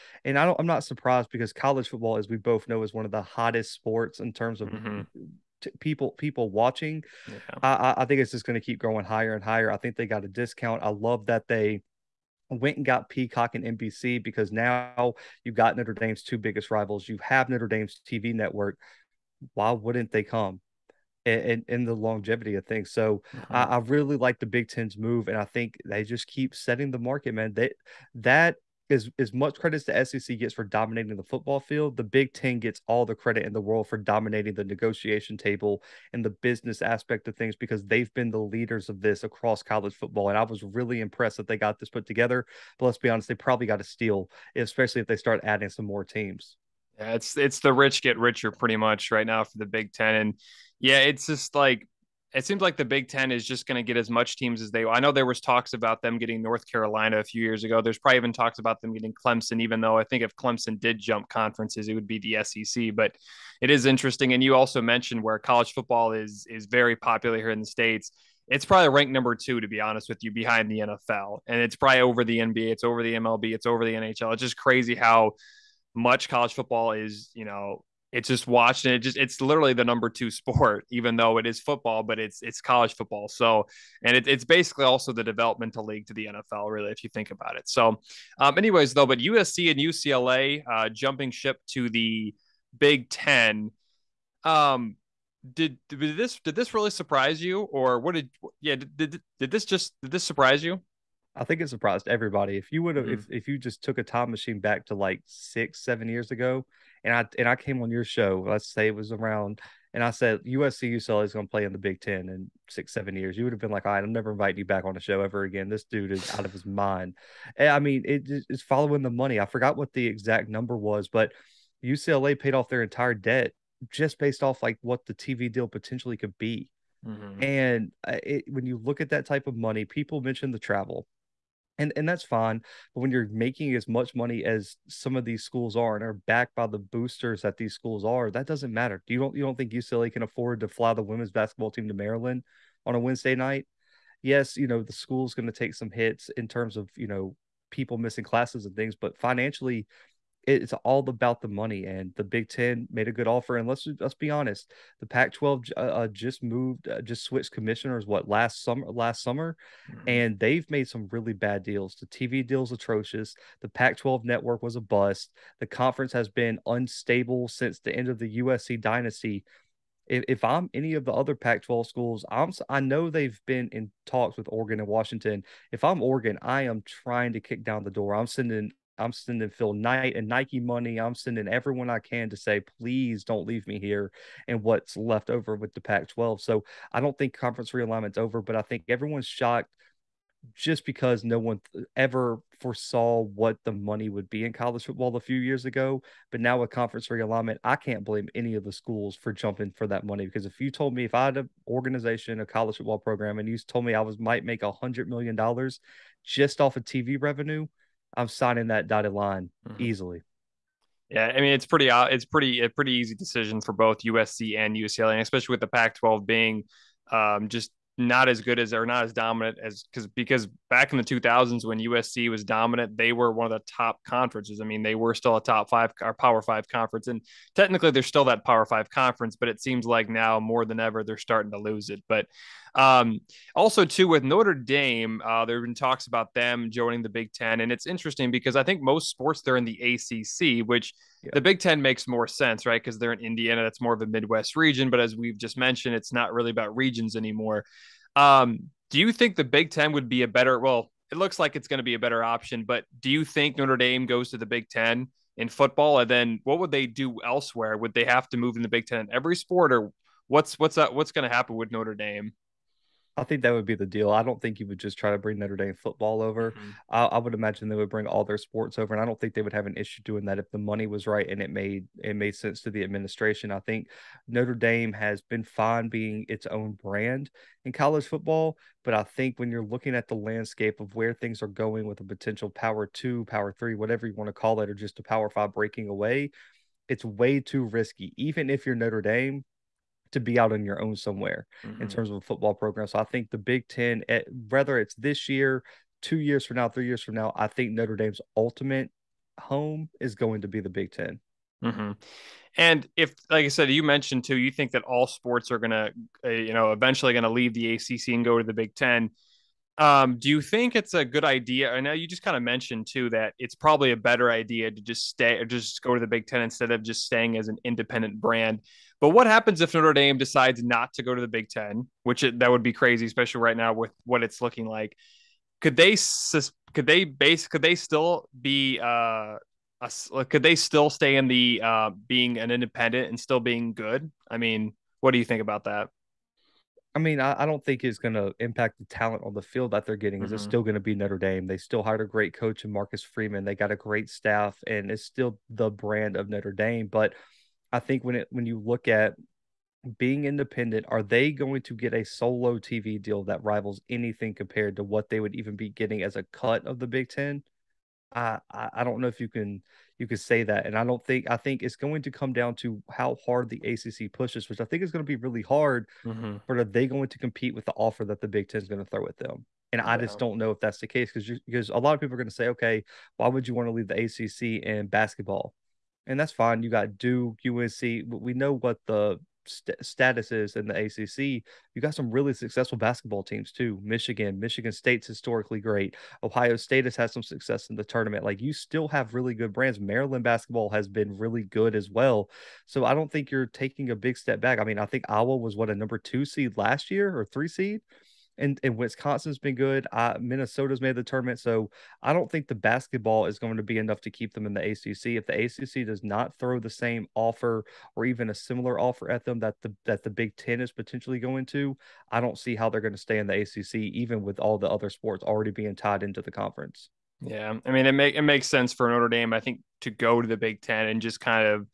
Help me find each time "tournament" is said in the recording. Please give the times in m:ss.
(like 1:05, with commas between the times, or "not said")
6:27, 6:41.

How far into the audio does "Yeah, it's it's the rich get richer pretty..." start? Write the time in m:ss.
0:46.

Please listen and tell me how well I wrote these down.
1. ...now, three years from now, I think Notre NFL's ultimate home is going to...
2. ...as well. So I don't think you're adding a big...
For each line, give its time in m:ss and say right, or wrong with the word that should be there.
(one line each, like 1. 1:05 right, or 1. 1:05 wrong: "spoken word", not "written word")
1. 4:56 wrong: "Dame", not "NFL"
2. 6:31 wrong: "taking", not "adding".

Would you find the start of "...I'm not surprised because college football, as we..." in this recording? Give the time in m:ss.
0:00.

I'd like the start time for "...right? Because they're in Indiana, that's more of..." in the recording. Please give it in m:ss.
4:02.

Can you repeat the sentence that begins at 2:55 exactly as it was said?
If I'm Oregon, I am trying to kick down the door.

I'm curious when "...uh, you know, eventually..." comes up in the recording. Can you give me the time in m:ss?
5:06.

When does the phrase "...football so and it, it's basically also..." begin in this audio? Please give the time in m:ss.
1:22.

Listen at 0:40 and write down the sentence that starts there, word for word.
And I was really impressed that they got this put together.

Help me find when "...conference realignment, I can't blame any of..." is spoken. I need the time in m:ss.
3:16.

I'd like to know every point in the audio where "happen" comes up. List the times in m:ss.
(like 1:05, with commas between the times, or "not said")
4:21, 5:19.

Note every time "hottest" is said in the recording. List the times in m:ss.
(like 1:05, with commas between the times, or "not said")
0:03.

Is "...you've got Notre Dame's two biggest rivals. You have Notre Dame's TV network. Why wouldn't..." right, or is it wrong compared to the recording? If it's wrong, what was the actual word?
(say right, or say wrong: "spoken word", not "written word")
right.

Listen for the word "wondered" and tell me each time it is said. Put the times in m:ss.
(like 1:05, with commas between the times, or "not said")
not said.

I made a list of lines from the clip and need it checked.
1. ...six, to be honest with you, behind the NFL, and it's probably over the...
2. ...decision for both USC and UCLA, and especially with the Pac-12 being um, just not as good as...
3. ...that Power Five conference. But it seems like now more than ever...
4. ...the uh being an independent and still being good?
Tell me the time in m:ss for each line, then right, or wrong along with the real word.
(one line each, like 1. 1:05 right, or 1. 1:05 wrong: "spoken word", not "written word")
1. 1:09 wrong: "two", not "six"
2. 3:33 right
3. 3:48 right
4. 5:31 right.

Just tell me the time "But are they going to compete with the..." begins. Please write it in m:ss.
6:06.